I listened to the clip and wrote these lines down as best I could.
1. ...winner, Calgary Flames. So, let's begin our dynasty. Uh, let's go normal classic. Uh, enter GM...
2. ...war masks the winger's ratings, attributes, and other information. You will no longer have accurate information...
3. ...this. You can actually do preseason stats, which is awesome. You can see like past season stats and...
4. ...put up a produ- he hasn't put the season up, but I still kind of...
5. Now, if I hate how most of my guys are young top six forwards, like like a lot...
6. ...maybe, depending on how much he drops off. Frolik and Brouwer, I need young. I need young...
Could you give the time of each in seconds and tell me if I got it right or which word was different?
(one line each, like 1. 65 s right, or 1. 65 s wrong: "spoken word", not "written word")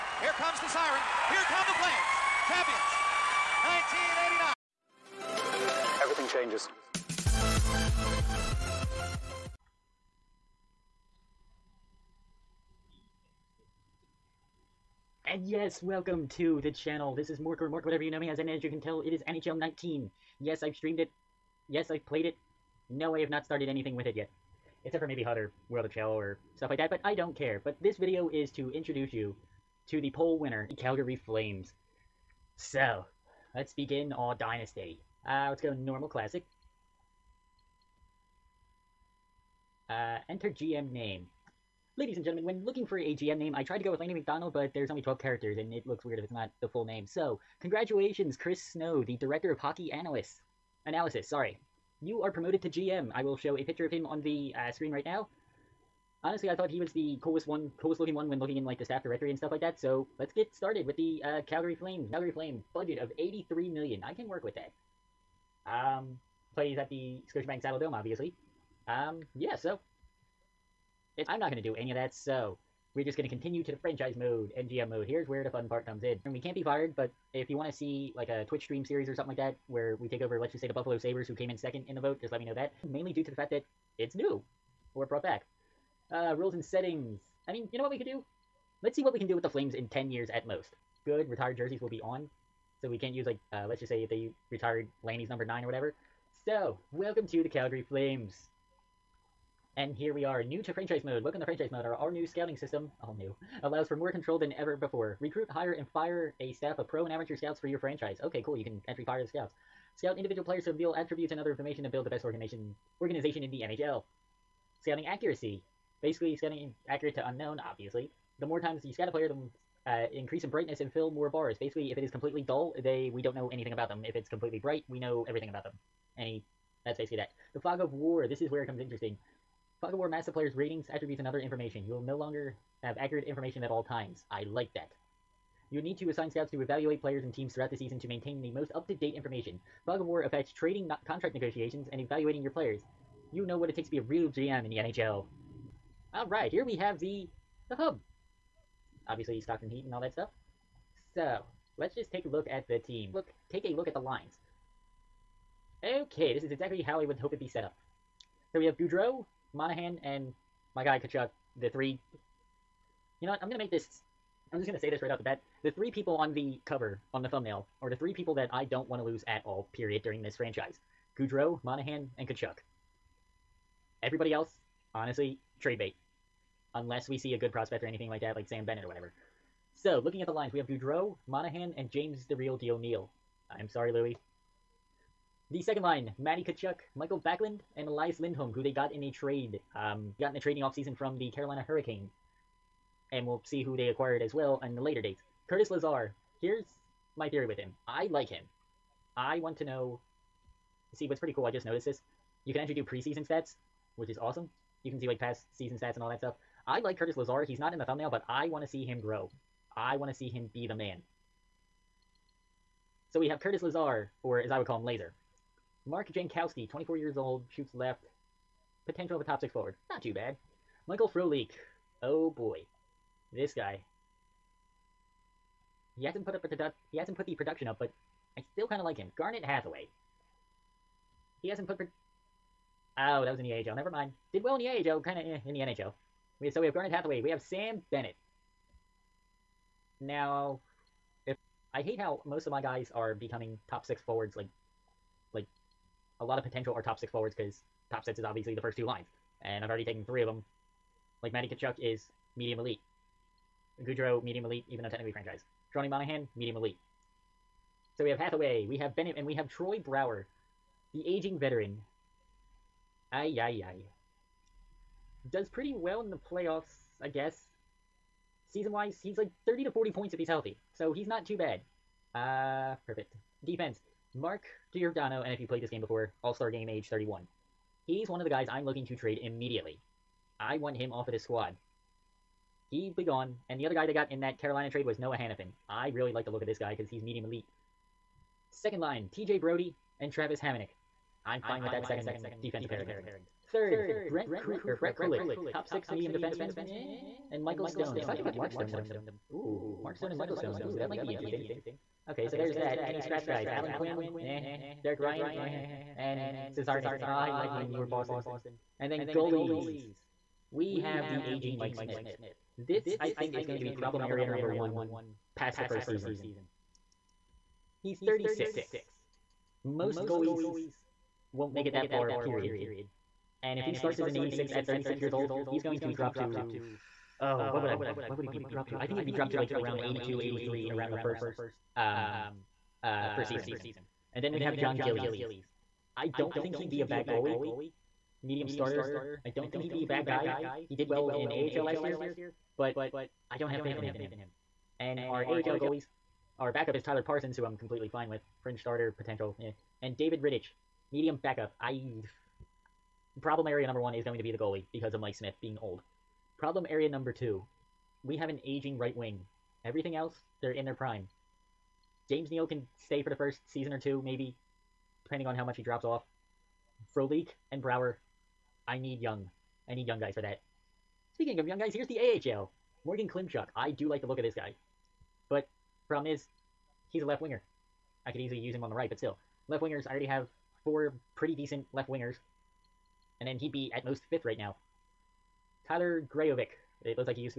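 1. 30 s right
2. 129 s wrong: "player", not "winger"
3. 201 s right
4. 226 s wrong: "production", not "season"
5. 239 s wrong: "becoming", not "young"
6. 364 s right.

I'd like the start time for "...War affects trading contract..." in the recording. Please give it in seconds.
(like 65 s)
140 s.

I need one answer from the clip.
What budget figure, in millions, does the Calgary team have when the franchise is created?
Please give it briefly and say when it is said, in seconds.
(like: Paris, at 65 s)
83 million, at 63 s.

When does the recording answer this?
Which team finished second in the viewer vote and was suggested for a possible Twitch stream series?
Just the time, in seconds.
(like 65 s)
80 s.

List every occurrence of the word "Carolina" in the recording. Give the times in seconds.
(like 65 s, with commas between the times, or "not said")
191 s, 284 s.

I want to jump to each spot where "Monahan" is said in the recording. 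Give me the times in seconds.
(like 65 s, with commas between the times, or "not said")
159 s, 171 s, 181 s, 255 s.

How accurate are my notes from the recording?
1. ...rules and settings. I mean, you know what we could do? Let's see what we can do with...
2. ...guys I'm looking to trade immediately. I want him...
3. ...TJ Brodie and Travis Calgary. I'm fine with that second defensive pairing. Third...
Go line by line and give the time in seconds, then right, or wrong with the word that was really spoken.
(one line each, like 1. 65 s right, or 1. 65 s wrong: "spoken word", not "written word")
1. 86 s right
2. 278 s right
3. 289 s wrong: "Hamonic", not "Calgary".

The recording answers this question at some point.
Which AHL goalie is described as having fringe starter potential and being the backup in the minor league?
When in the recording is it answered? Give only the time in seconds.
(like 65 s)
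346 s.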